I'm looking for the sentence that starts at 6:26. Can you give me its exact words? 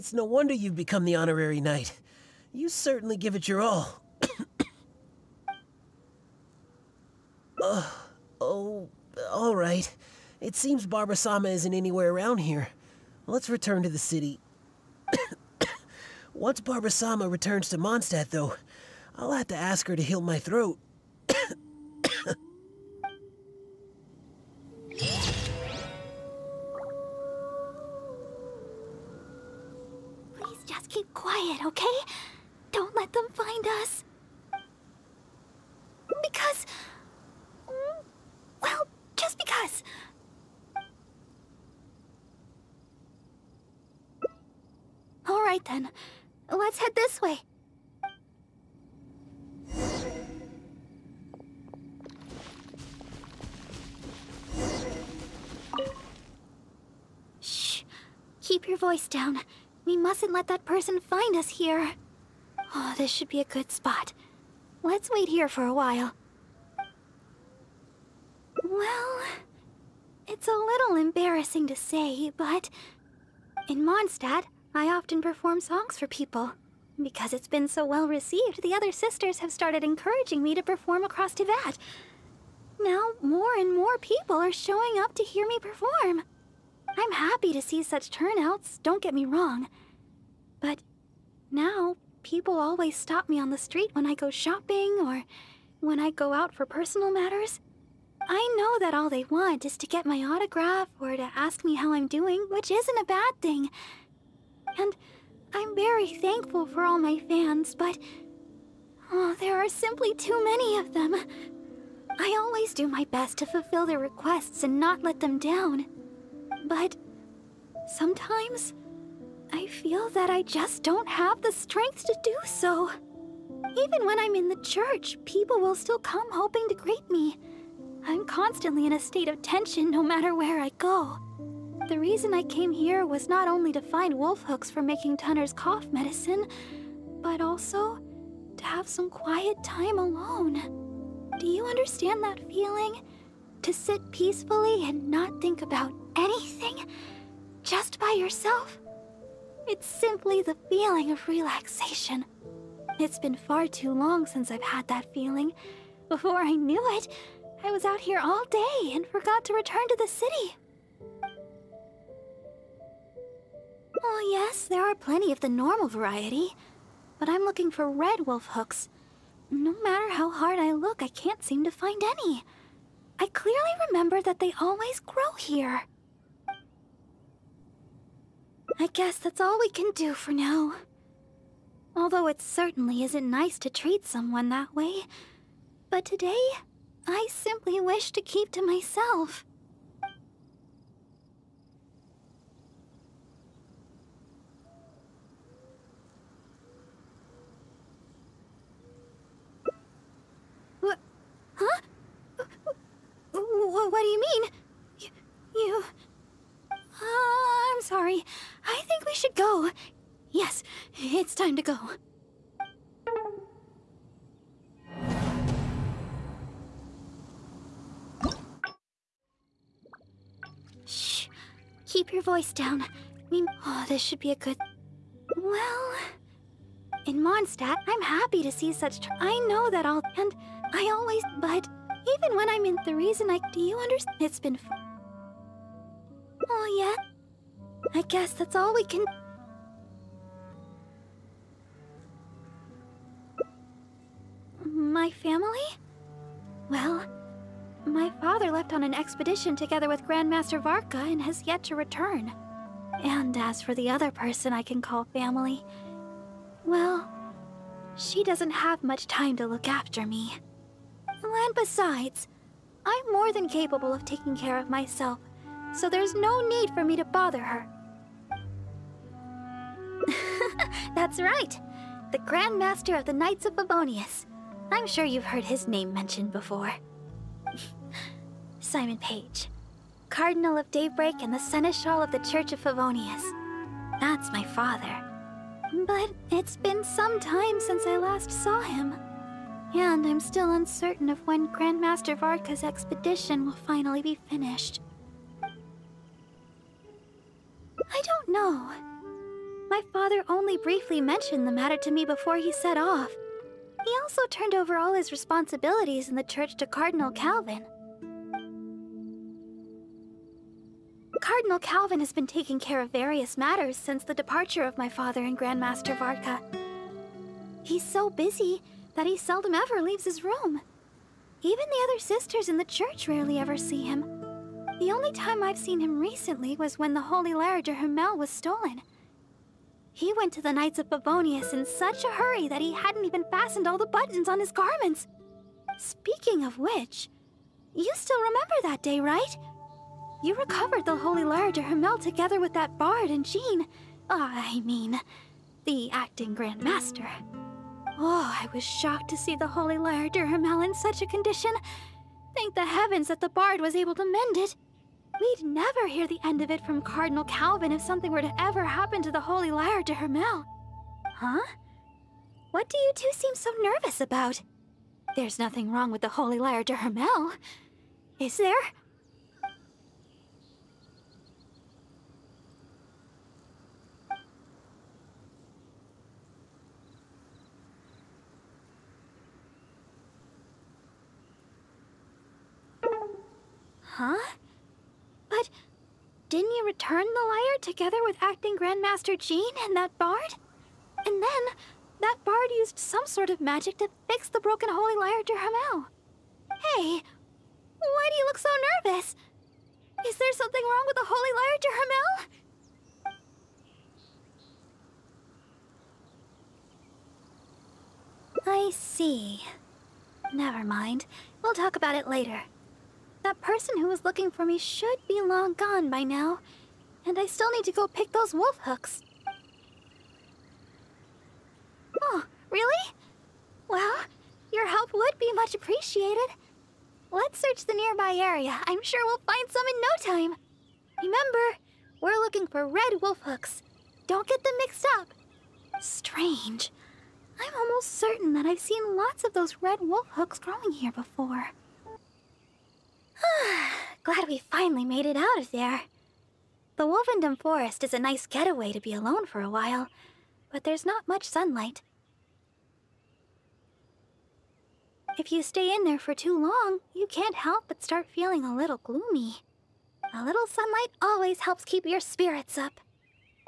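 return the lyre together with acting Grandmaster Jean and that bard?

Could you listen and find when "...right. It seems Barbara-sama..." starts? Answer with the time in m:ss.
0:09.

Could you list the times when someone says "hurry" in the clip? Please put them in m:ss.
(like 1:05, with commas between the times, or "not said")
5:32.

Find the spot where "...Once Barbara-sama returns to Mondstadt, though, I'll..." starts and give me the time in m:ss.
0:16.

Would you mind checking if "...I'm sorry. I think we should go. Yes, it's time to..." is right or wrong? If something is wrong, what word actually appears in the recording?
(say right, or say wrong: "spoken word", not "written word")
right.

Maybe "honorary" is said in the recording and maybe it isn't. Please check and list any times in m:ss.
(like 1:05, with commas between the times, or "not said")
0:01.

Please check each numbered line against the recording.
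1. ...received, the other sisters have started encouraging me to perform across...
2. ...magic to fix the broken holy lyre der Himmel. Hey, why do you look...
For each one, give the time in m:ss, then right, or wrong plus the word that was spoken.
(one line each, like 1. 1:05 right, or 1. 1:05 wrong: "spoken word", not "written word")
1. 1:18 right
2. 6:33 right.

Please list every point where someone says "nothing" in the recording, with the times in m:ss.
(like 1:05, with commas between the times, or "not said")
6:05.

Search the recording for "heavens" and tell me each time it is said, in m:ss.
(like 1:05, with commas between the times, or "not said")
5:52.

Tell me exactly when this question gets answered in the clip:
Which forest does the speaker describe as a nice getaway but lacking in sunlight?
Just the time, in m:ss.
7:26.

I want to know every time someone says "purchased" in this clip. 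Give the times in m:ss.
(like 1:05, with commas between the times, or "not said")
not said.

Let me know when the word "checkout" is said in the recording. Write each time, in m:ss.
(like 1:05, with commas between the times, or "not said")
not said.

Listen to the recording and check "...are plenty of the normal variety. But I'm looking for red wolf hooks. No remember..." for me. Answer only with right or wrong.
wrong.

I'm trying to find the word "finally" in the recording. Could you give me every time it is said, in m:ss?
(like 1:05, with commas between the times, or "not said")
4:53, 7:24.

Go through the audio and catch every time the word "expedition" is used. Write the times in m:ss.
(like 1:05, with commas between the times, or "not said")
4:08, 4:52.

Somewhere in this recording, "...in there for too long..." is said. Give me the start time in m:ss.
7:35.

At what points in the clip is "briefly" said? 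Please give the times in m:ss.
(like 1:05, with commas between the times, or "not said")
5:00.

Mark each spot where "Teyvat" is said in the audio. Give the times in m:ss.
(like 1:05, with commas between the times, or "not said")
1:21.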